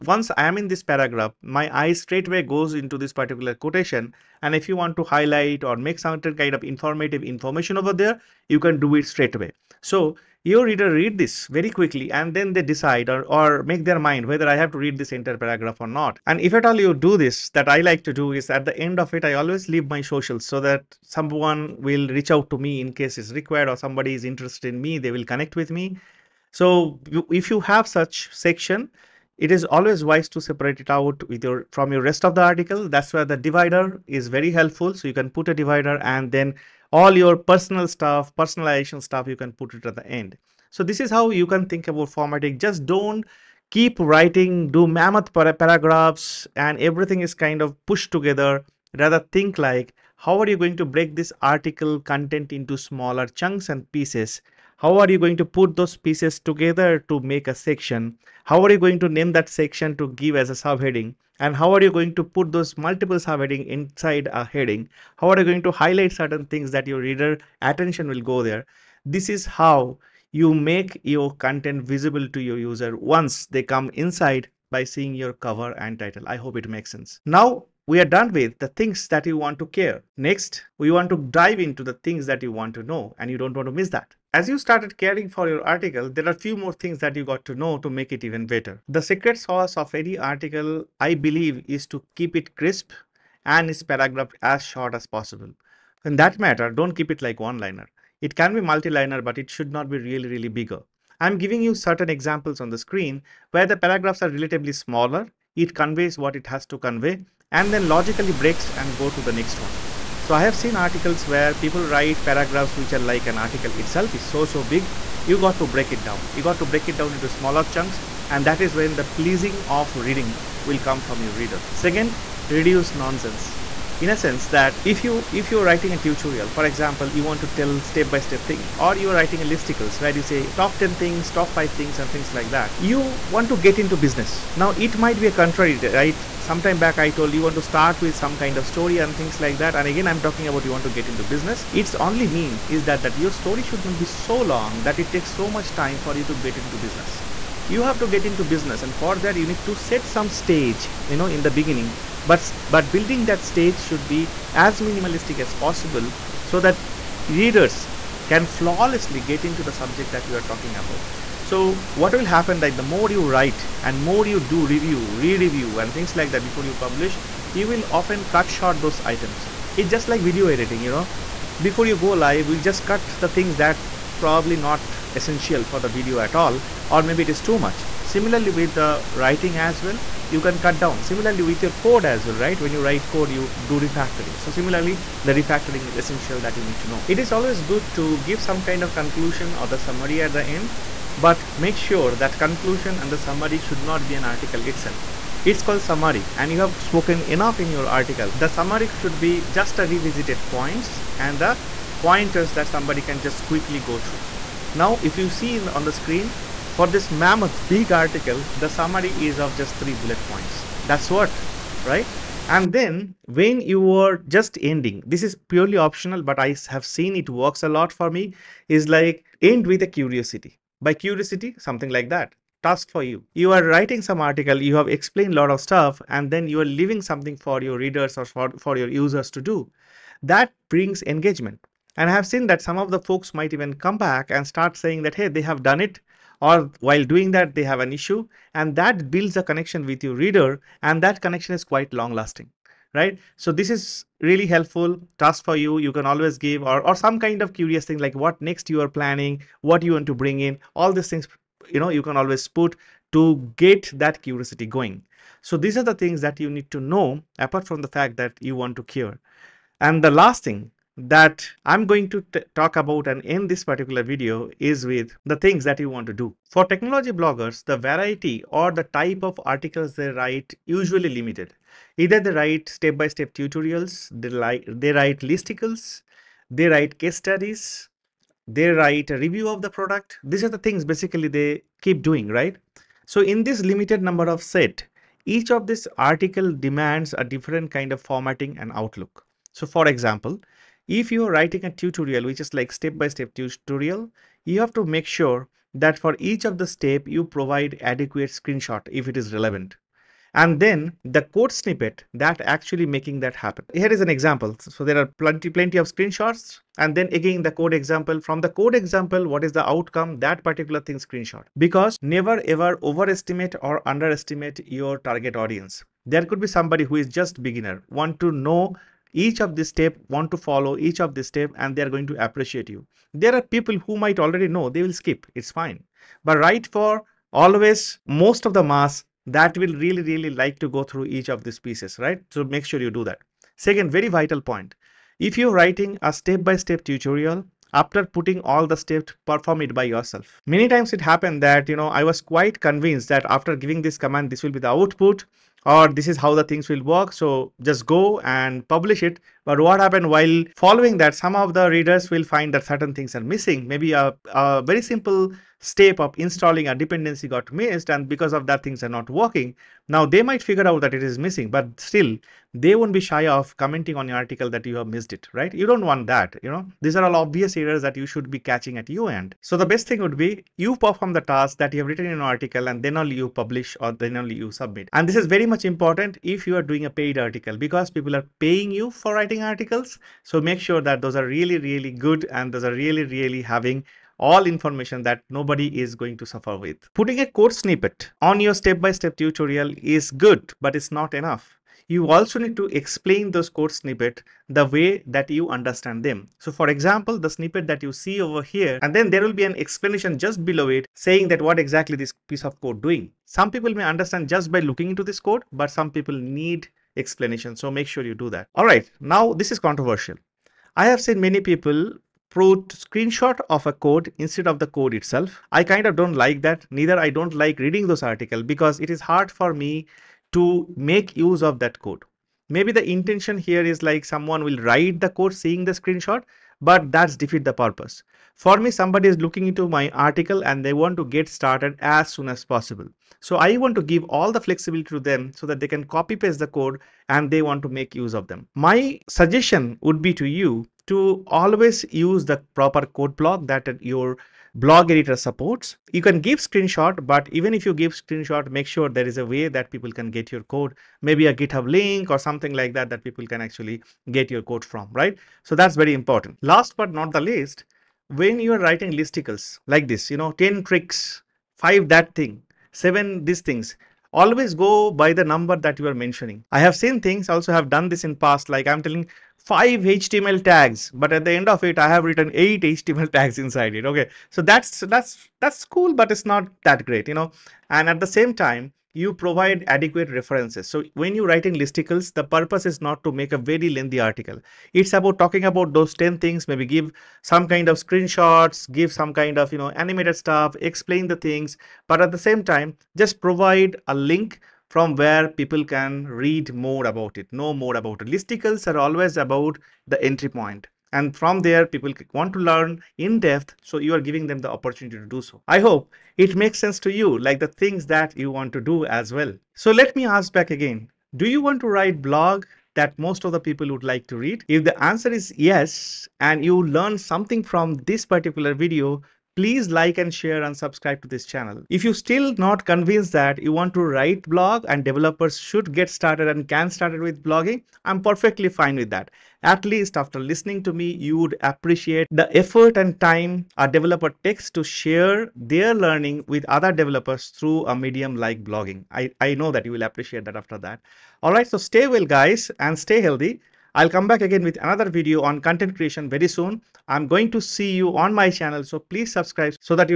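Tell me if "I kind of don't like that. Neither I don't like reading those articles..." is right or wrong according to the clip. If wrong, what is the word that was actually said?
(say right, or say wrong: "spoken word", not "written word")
right.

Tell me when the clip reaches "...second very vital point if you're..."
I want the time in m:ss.
5:33.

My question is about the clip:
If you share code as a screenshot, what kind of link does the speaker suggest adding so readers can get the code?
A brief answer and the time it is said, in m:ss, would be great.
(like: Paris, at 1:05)
GitHub link, at 7:31.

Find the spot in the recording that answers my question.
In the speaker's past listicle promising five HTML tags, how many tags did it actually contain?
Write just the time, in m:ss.
7:52.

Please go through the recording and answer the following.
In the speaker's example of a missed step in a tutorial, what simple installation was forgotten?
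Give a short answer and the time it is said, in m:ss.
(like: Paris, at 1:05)
a dependency, at 5:56.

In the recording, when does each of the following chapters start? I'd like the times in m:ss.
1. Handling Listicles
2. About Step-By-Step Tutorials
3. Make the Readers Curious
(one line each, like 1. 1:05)
1. 7:35
2. 4:19
3. 0:15.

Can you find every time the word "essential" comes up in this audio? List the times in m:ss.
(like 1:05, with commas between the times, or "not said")
2:55, 3:06.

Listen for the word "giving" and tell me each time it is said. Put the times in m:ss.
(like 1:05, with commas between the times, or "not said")
1:41, 5:43, 8:24.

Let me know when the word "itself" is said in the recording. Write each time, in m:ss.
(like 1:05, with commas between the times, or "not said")
1:53, 3:14, 6:54.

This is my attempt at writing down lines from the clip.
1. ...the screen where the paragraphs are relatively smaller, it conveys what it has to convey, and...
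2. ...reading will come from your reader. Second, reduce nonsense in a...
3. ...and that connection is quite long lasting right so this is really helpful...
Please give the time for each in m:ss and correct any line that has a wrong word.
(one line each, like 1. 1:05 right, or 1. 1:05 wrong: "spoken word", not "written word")
1. 1:42 right
2. 1:59 right
3. 4:00 right.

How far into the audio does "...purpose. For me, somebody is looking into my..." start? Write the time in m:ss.
7:07.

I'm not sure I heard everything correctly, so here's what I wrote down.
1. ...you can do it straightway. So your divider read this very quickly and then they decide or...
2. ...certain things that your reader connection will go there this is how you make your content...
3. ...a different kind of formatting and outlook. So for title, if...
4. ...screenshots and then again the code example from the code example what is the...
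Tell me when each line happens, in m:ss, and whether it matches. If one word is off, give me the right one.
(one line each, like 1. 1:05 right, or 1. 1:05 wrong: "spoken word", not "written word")
1. 0:08 wrong: "reader", not "divider"
2. 1:06 wrong: "attention", not "connection"
3. 4:47 wrong: "example", not "title"
4. 5:05 right.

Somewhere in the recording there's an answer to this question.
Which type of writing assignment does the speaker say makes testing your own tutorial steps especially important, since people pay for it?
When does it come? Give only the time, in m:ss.
6:16.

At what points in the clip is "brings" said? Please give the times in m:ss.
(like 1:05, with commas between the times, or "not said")
3:50, 4:10.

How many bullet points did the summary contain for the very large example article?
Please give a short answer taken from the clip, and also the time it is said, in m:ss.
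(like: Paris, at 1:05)
3, at 3:29.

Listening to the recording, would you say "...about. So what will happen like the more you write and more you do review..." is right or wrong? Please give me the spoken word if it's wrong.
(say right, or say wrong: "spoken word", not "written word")
right.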